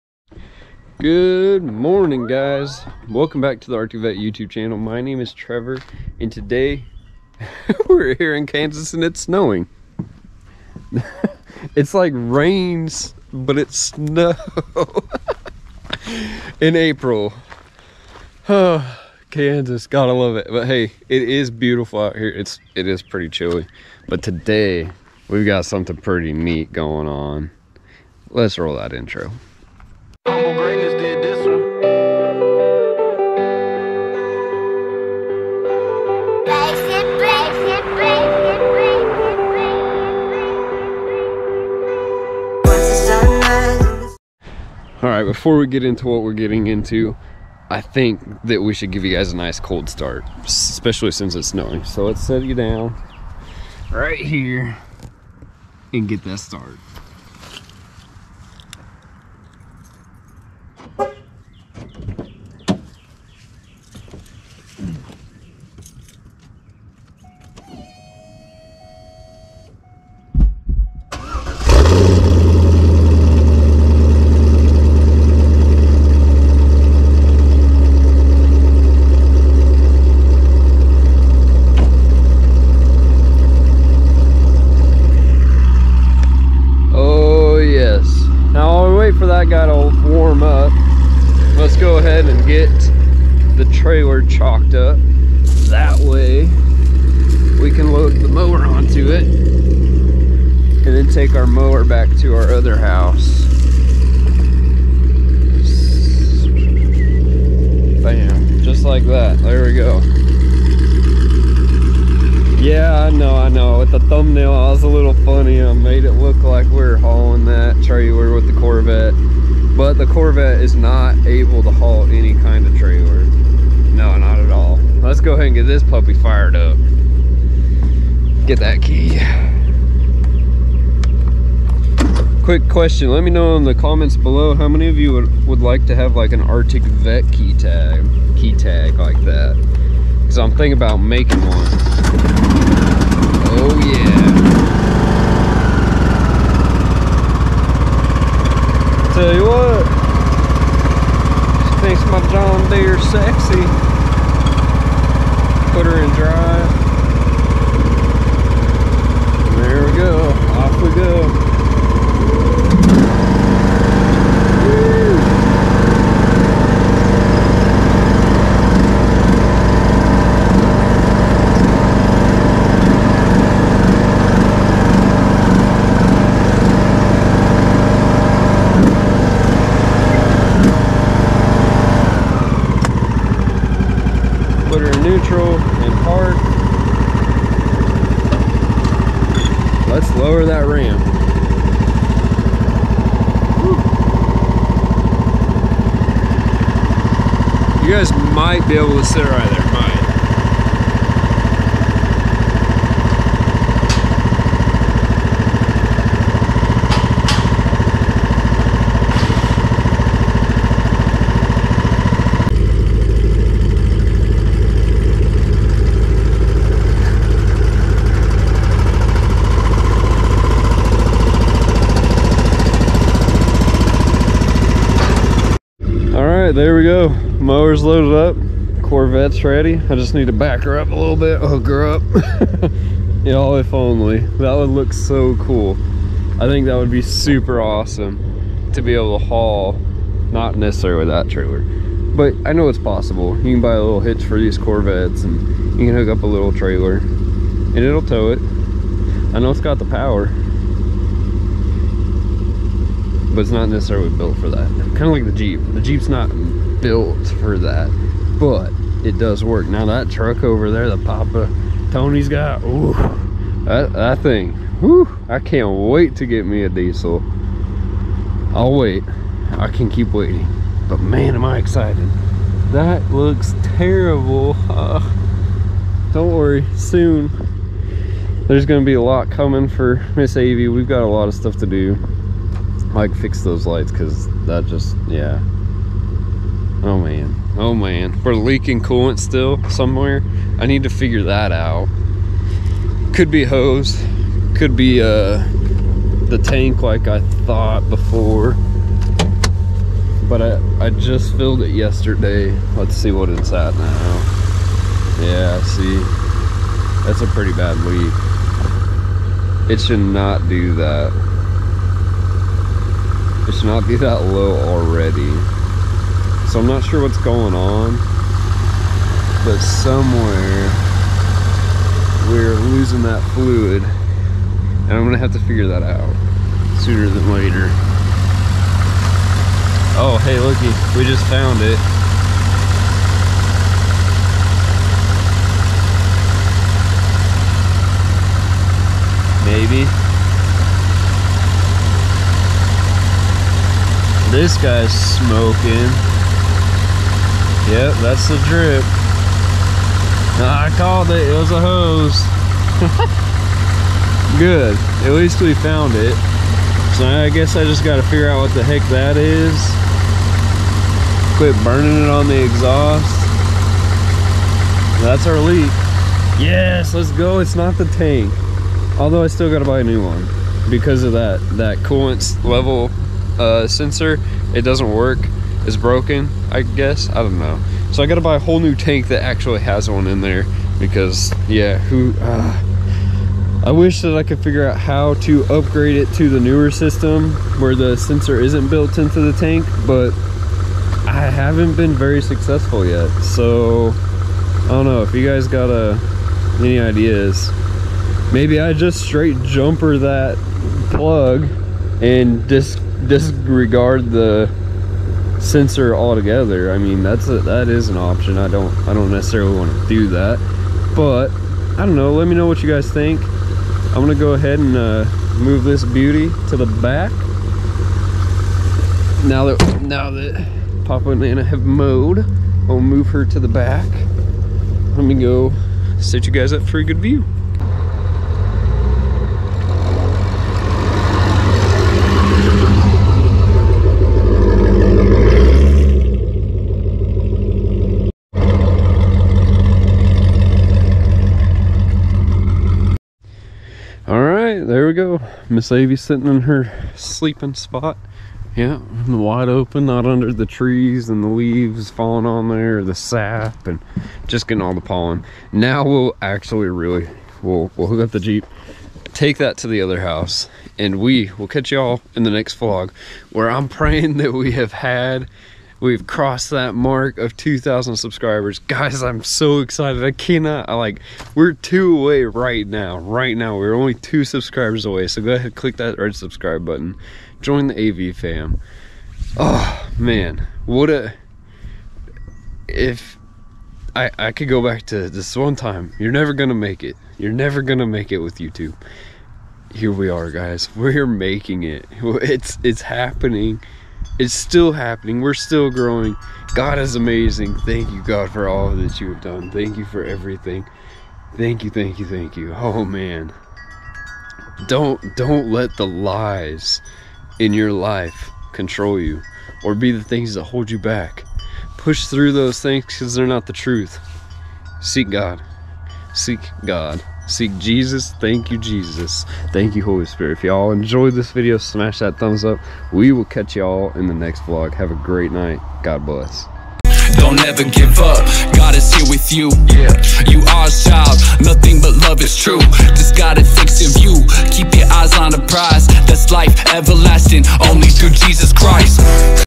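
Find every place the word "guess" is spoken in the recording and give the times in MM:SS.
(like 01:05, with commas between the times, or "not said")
05:57, 06:16.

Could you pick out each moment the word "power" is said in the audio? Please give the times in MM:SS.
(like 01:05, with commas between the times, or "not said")
04:09.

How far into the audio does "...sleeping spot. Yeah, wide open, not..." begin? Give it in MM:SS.
07:26.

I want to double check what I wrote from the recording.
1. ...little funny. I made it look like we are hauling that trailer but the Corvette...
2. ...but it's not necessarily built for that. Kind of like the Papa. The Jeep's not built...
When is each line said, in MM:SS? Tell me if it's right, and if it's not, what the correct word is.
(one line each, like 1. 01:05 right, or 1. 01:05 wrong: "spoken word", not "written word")
1. 01:54 right
2. 04:13 wrong: "Jeep", not "Papa".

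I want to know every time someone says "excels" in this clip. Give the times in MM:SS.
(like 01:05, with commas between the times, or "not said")
not said.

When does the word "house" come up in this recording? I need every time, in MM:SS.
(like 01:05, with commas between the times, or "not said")
01:42, 07:40.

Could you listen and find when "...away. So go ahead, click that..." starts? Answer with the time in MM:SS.
07:54.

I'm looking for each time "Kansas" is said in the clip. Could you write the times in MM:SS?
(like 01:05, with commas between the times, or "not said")
00:08, 00:19.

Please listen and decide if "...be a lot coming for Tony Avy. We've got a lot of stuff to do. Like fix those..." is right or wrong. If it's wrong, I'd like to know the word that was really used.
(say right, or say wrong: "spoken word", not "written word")
wrong: "Miss", not "Tony".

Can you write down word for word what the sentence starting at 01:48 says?
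Bam, just like that, there we go.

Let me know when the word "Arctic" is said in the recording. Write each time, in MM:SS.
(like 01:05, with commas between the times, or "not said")
00:03, 02:16.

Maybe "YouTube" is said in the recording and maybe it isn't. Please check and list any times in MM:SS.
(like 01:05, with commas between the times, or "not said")
00:04, 08:08.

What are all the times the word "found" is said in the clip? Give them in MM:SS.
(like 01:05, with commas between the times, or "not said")
05:31, 05:55.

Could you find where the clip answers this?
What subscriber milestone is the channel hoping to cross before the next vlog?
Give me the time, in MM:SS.
07:47.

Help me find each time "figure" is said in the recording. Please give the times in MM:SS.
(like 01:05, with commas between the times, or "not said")
04:50, 05:25, 05:58, 06:24.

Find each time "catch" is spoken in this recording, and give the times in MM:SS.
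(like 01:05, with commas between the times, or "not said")
07:41, 08:43.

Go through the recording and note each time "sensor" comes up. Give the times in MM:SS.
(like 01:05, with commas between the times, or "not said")
06:13, 06:27, 06:45.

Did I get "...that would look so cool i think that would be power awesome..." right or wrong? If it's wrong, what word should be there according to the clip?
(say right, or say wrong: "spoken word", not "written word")
wrong: "super", not "power".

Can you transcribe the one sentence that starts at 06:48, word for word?
I don't I don't necessarily want to do that, but I don't know.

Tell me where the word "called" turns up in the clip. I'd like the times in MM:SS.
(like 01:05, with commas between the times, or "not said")
05:50.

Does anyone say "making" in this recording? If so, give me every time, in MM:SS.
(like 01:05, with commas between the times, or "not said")
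02:20, 08:11.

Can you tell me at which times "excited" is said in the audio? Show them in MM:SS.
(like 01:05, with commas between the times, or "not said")
04:31, 07:49.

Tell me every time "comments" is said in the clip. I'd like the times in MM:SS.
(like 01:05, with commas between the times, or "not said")
02:13.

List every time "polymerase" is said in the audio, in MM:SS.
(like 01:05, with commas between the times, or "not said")
not said.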